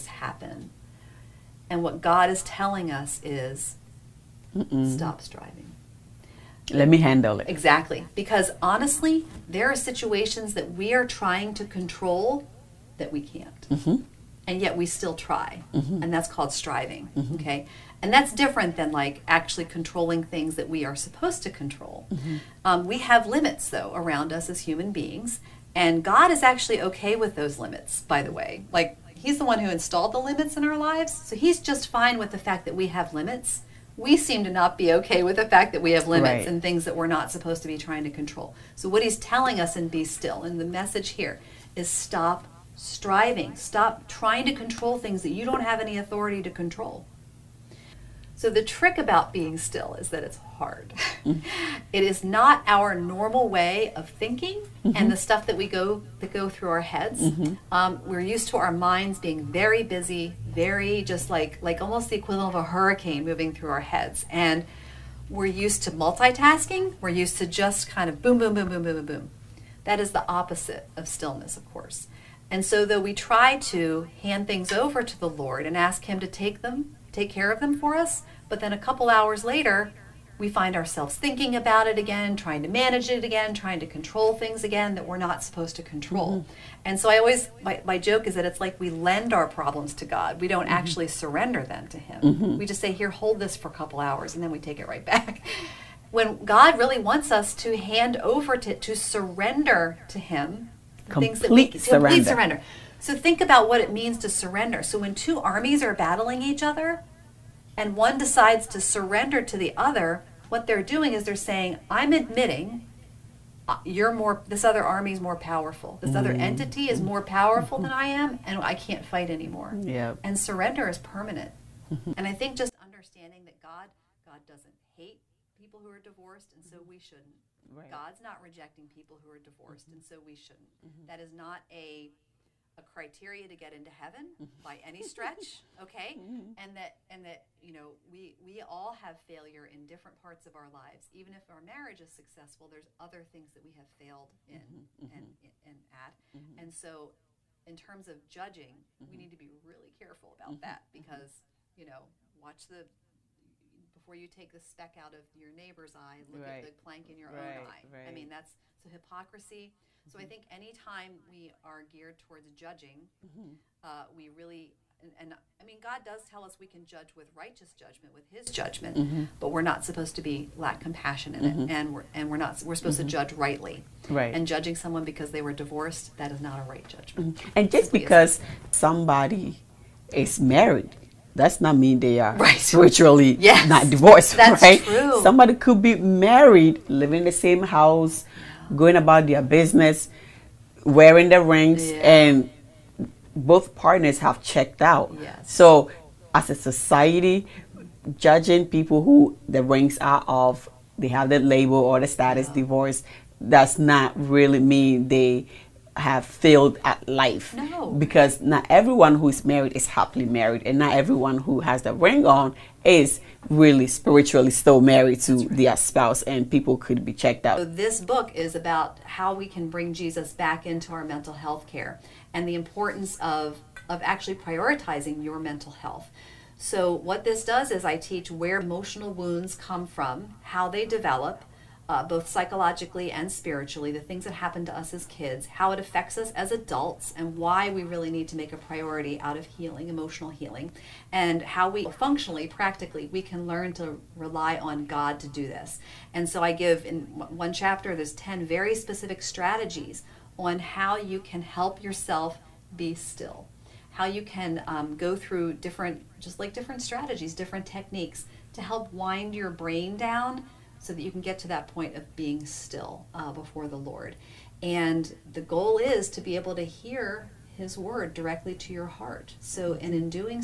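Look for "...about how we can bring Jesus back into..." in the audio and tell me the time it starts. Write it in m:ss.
3:38.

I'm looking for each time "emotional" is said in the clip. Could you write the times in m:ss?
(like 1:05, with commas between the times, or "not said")
3:48, 3:59.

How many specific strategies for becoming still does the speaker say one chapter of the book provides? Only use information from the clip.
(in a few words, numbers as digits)
10.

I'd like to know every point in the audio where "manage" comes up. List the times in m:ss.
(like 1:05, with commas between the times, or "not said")
1:22.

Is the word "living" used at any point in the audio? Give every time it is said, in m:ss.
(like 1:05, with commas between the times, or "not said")
3:06.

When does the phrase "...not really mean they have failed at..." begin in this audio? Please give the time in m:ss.
3:23.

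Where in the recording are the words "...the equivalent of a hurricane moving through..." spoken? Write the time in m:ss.
1:02.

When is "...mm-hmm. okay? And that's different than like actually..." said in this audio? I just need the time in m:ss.
0:17.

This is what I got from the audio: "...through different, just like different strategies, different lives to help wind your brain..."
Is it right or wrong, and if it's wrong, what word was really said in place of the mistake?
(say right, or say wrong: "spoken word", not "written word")
wrong: "techniques", not "lives".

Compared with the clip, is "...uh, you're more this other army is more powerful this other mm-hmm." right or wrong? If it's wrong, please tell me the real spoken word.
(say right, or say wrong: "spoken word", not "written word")
right.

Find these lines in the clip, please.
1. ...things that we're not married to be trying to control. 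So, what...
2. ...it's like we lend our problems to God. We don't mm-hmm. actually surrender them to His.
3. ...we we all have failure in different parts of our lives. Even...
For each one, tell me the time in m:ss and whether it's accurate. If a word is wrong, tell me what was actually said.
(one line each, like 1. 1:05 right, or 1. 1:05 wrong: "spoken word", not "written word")
1. 0:36 wrong: "supposed", not "married"
2. 1:28 wrong: "Him", not "His"
3. 2:18 right.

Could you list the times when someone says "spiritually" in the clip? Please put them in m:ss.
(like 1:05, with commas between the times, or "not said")
3:02, 3:33, 3:53.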